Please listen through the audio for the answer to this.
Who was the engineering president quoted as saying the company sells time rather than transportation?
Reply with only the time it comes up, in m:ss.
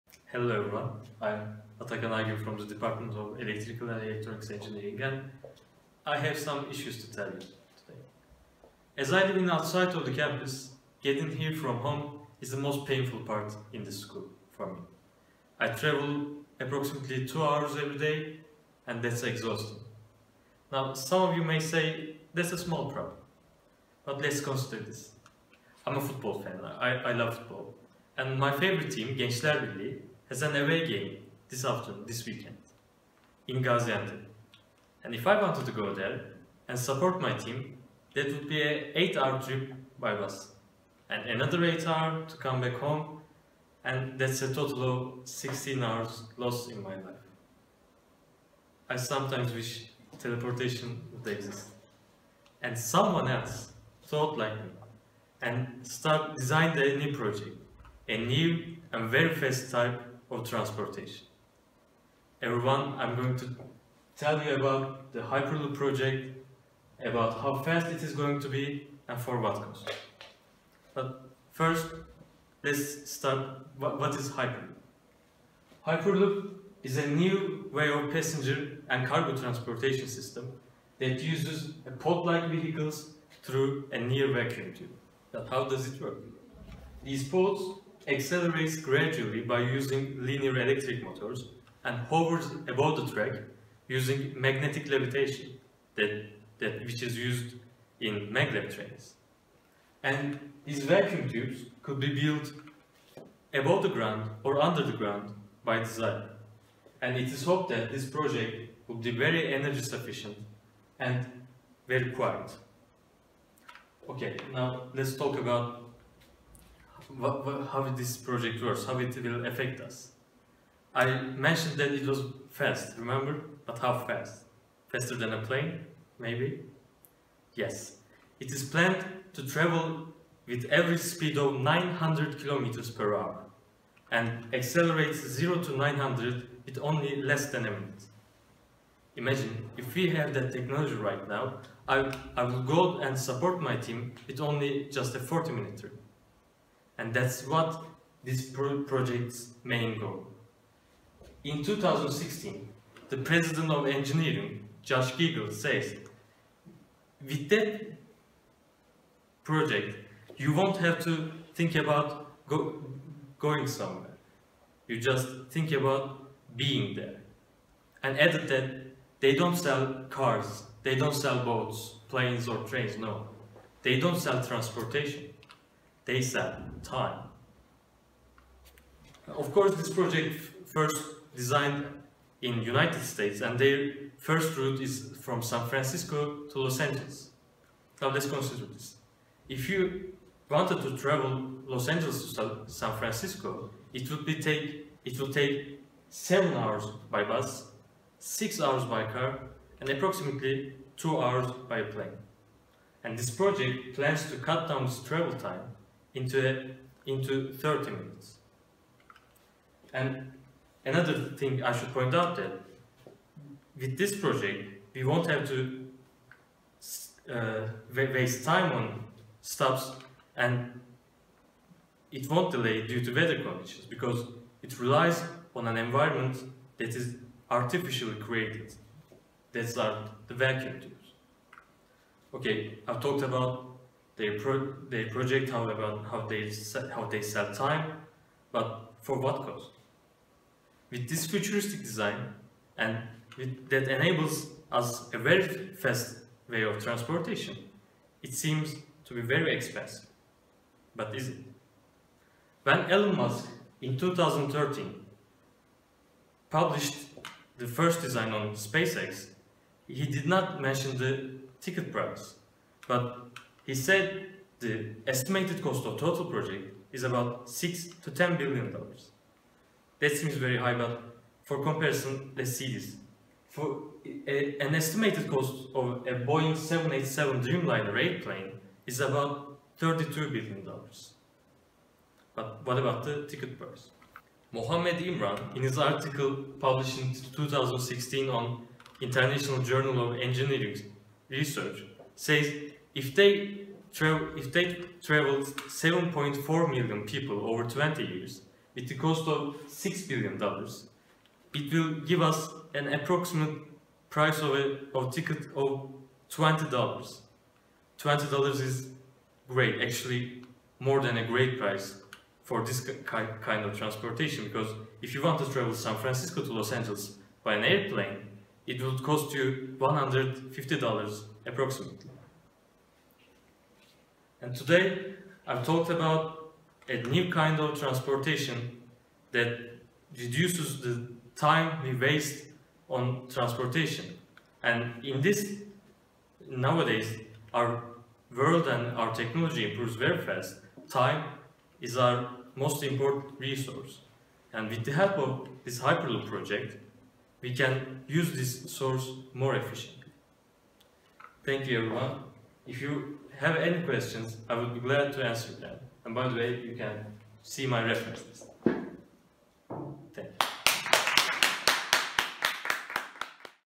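2:34.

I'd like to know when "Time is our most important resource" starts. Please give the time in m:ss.
5:40.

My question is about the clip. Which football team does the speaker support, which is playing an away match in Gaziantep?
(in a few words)
Gençler Birliği.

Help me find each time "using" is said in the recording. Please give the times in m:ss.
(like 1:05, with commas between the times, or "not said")
1:29, 1:33.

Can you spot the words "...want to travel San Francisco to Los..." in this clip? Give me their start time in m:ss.
5:15.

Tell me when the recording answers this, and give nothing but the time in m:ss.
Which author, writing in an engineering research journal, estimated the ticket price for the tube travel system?
4:44.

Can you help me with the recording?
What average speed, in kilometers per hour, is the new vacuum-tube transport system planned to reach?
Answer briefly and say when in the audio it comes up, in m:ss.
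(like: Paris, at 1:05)
900, at 2:11.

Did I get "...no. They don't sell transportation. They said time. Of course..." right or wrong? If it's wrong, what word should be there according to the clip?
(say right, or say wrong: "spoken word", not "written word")
right.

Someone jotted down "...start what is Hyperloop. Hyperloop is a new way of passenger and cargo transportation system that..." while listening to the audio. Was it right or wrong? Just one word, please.
right.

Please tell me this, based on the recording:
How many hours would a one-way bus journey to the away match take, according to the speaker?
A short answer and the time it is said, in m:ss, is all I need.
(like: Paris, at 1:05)
8, at 0:39.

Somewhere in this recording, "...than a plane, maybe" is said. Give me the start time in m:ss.
2:05.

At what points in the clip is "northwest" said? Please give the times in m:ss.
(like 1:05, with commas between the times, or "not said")
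not said.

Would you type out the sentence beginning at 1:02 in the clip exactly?
Everyone, I'm going to tell you about the Hyperloop project, about how fast it is going to be and for what cost.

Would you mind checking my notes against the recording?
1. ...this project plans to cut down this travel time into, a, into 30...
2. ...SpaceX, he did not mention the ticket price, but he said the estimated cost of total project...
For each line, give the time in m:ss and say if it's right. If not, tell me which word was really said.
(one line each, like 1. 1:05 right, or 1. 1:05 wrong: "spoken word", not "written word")
1. 3:23 right
2. 4:18 right.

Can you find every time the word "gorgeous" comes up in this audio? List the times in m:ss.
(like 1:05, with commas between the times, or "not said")
not said.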